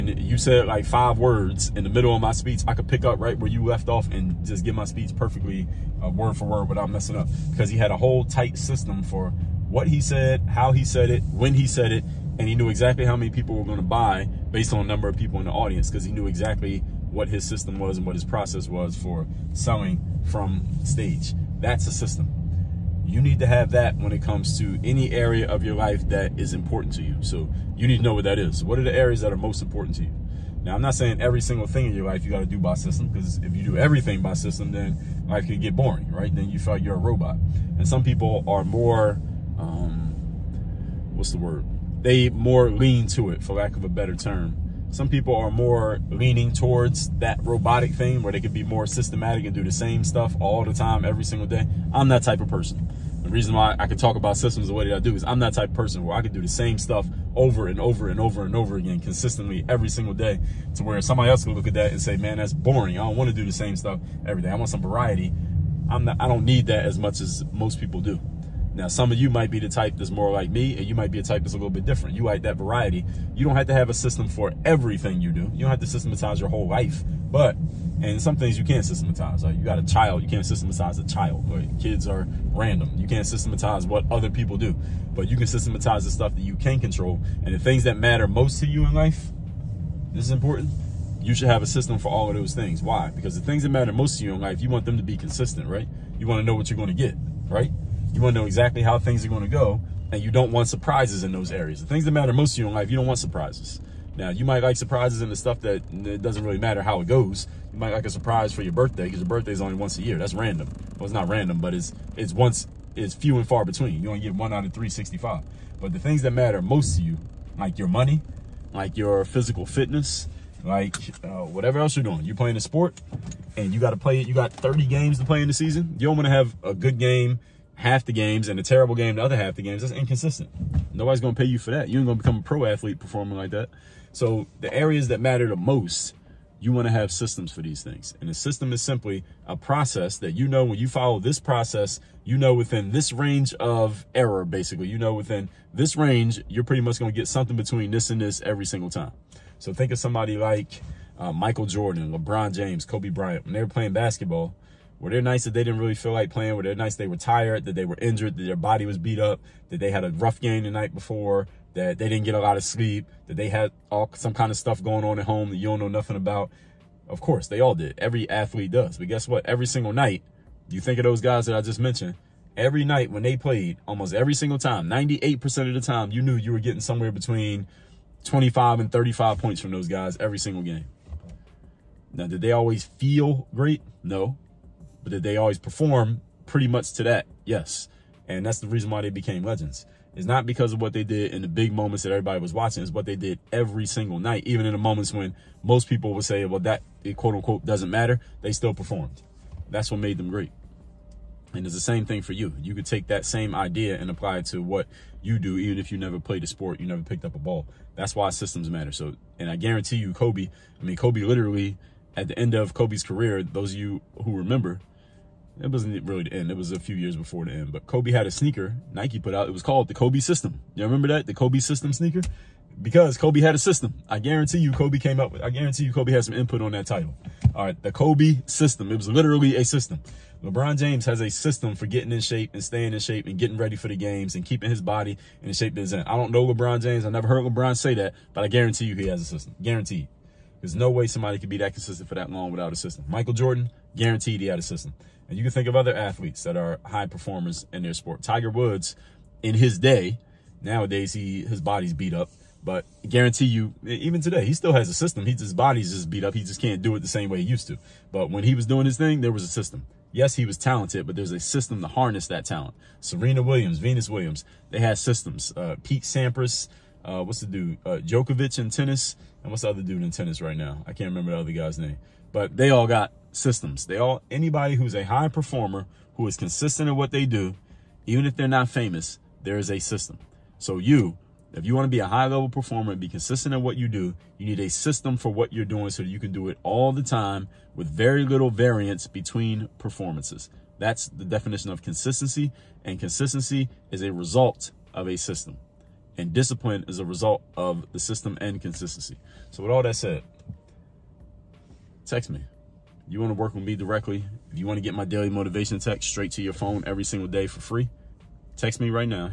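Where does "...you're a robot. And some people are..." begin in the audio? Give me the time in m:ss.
0:36.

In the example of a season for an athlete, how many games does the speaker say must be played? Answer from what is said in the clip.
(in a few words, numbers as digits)
30.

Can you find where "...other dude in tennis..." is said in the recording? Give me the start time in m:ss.
4:29.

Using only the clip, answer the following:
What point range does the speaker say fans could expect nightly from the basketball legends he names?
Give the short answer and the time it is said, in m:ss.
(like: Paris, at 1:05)
25 to 35 points, at 2:57.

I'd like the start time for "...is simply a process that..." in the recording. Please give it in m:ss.
2:18.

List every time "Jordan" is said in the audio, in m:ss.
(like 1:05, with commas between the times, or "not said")
2:31, 4:03.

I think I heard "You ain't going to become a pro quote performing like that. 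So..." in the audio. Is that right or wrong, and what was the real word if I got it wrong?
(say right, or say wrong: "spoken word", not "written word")
wrong: "athlete", not "quote".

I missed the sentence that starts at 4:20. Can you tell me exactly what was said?
Yes, he was talented, but there's a system to harness that talent.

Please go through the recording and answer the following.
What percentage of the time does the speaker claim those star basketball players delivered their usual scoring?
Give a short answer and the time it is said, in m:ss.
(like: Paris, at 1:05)
98%, at 2:54.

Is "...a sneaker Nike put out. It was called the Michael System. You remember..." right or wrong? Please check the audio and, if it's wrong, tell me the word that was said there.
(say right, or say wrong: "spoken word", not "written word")
wrong: "Kobe", not "Michael".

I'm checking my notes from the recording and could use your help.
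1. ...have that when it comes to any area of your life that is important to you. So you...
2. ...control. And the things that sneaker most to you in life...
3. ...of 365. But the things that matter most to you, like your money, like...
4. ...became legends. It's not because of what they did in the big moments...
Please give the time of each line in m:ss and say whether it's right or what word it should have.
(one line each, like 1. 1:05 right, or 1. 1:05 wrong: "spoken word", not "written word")
1. 0:23 right
2. 1:26 wrong: "matter", not "sneaker"
3. 1:54 right
4. 3:09 right.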